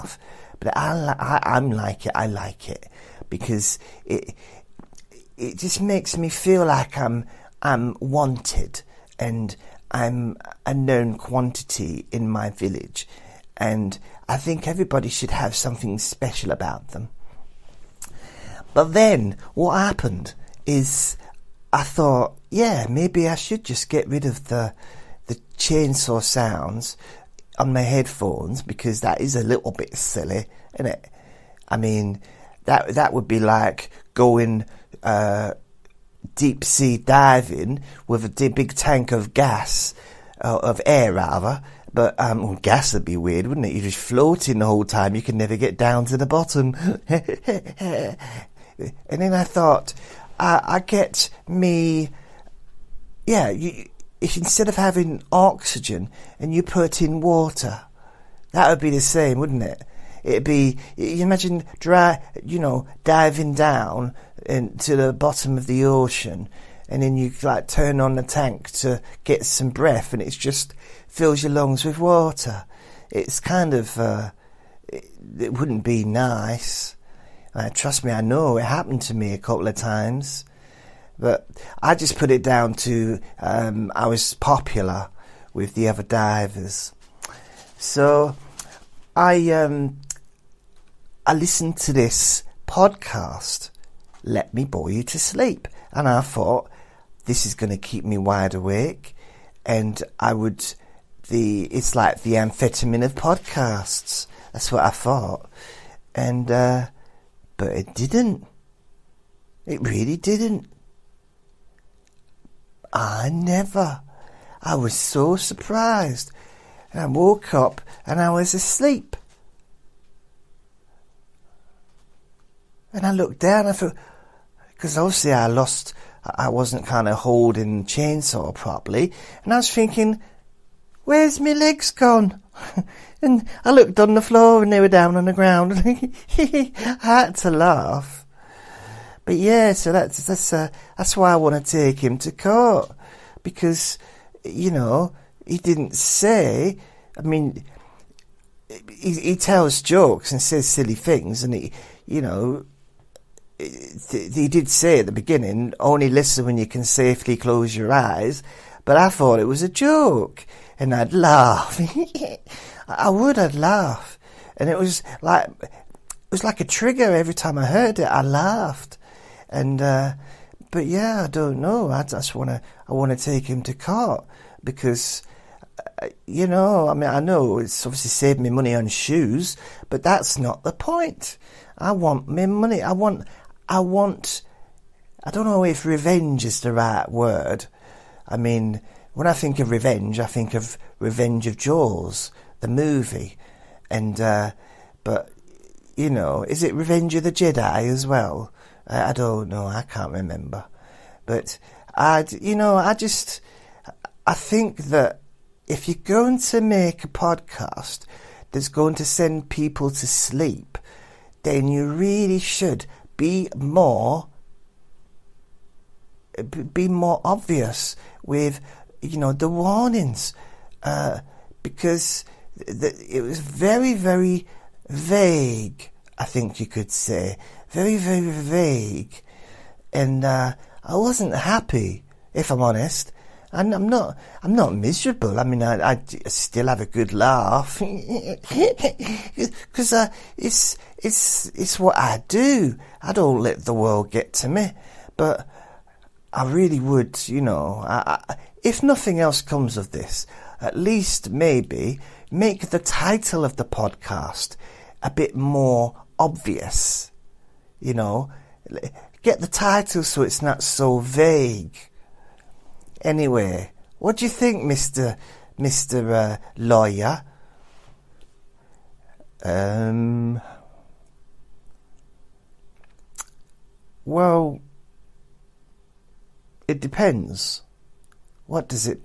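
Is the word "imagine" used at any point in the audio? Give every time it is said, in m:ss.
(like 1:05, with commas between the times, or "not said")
1:01.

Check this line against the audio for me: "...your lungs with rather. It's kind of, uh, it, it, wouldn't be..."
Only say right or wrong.
wrong.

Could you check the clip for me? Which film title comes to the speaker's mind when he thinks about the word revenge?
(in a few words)
Revenge of Jaws.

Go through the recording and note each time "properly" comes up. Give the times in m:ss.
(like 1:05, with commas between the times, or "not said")
2:08.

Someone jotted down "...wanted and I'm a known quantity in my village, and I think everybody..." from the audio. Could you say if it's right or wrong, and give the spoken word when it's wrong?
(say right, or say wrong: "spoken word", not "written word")
right.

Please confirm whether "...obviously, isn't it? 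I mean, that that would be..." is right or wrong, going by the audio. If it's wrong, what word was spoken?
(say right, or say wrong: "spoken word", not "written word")
wrong: "silly", not "obviously".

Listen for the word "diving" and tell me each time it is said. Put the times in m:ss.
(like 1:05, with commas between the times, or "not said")
0:36, 1:03.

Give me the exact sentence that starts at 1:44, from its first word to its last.
That's what I thought, and uh, but it didn't.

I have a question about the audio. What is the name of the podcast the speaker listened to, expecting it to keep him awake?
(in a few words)
Let Me Bore You to Sleep.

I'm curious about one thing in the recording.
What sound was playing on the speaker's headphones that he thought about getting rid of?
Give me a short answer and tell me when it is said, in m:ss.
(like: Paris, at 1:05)
Chainsaw sounds, at 0:25.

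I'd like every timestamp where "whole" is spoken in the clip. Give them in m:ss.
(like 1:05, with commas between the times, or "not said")
0:44.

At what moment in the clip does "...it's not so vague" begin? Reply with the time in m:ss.
4:20.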